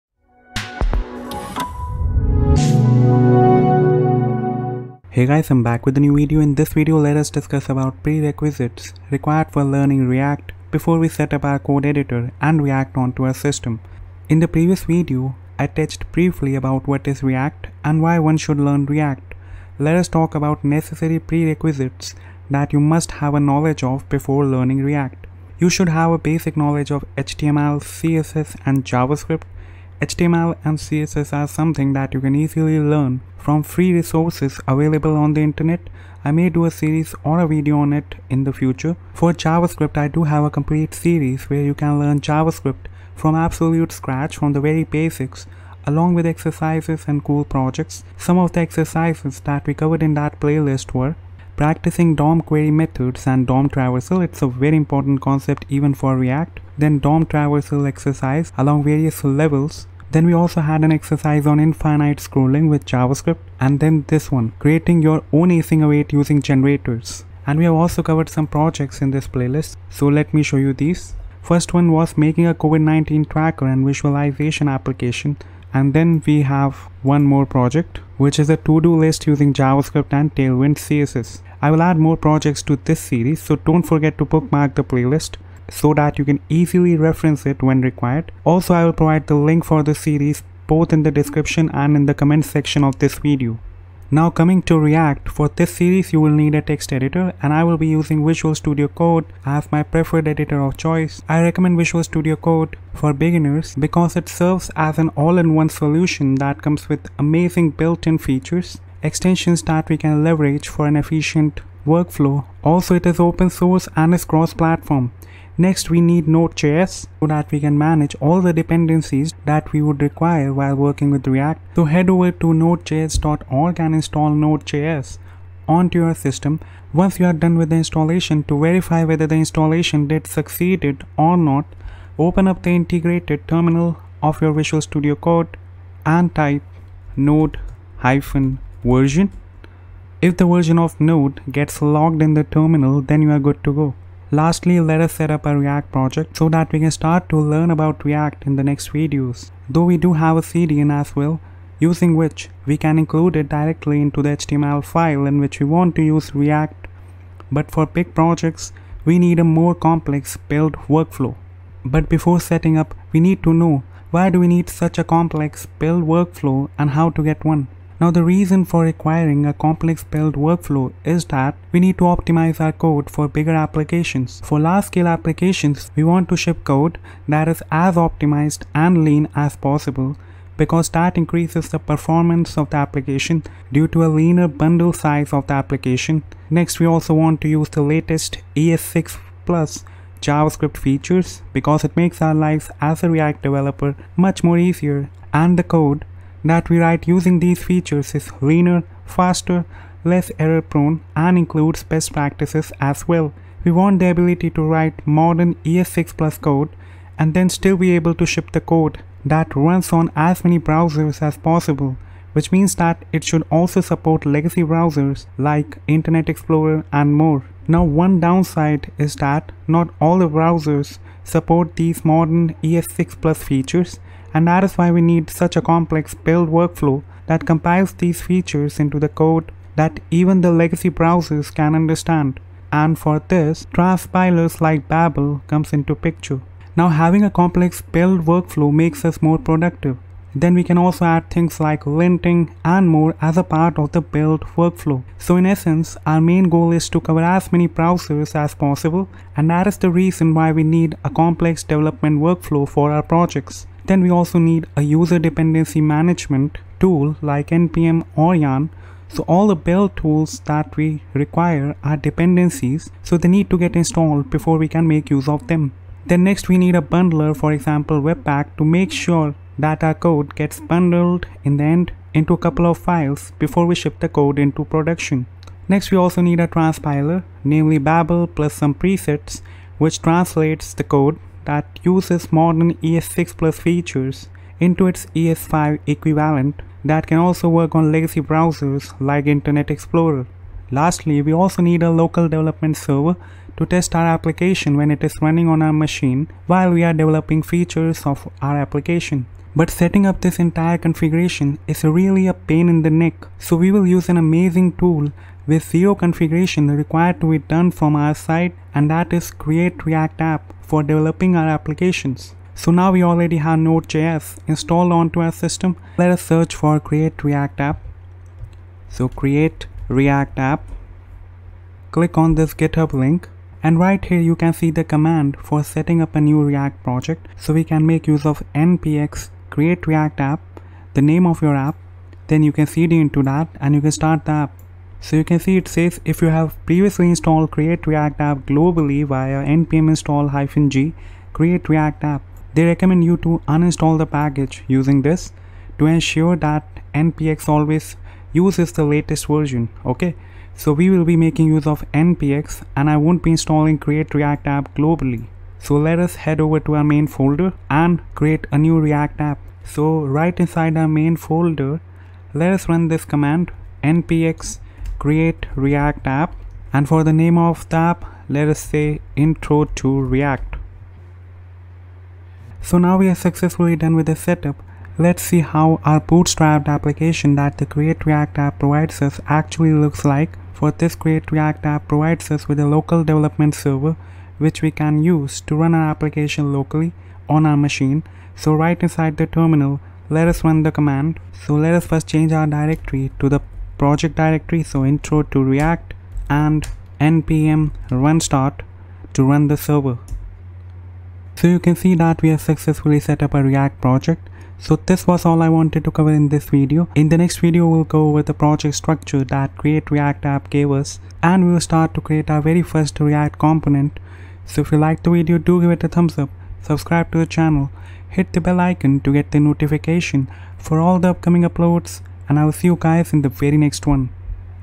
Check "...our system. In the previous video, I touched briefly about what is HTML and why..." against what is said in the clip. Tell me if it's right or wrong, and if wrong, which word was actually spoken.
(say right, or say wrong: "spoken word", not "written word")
wrong: "React", not "HTML".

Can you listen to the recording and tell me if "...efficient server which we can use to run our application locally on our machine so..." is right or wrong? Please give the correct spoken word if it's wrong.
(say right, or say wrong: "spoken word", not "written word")
wrong: "development", not "efficient".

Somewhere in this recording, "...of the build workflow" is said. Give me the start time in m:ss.
4:03.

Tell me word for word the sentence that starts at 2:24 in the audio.
Lastly, let us set up a React project so that we can start to learn about React in the next videos.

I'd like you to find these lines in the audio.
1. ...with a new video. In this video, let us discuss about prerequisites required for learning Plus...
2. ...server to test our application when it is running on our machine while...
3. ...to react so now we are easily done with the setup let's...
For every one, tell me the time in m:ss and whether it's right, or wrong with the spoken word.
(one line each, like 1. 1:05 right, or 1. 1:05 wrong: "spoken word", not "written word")
1. 0:05 wrong: "React", not "Plus"
2. 4:52 right
3. 6:09 wrong: "successfully", not "easily".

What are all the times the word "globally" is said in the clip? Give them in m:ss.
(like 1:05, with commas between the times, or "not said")
5:38, 5:54.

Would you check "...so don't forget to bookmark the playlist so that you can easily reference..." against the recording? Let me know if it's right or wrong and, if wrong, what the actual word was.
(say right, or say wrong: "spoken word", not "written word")
right.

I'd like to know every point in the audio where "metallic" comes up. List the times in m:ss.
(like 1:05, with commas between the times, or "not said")
not said.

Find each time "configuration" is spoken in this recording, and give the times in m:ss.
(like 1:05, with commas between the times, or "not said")
5:00, 5:05.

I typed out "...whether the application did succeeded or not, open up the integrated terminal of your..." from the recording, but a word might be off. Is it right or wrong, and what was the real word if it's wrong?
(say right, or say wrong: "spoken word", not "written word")
wrong: "installation", not "application".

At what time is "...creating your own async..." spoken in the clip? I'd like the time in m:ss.
1:04.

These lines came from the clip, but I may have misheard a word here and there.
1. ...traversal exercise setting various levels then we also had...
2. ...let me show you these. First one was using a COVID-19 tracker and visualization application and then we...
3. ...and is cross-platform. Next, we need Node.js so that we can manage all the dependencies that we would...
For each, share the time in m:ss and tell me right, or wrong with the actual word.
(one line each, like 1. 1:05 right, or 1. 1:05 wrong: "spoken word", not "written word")
1. 0:57 wrong: "along", not "setting"
2. 1:10 wrong: "making", not "using"
3. 1:53 right.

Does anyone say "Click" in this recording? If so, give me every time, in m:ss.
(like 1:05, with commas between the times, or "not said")
5:21.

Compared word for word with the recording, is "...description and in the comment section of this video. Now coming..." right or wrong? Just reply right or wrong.
right.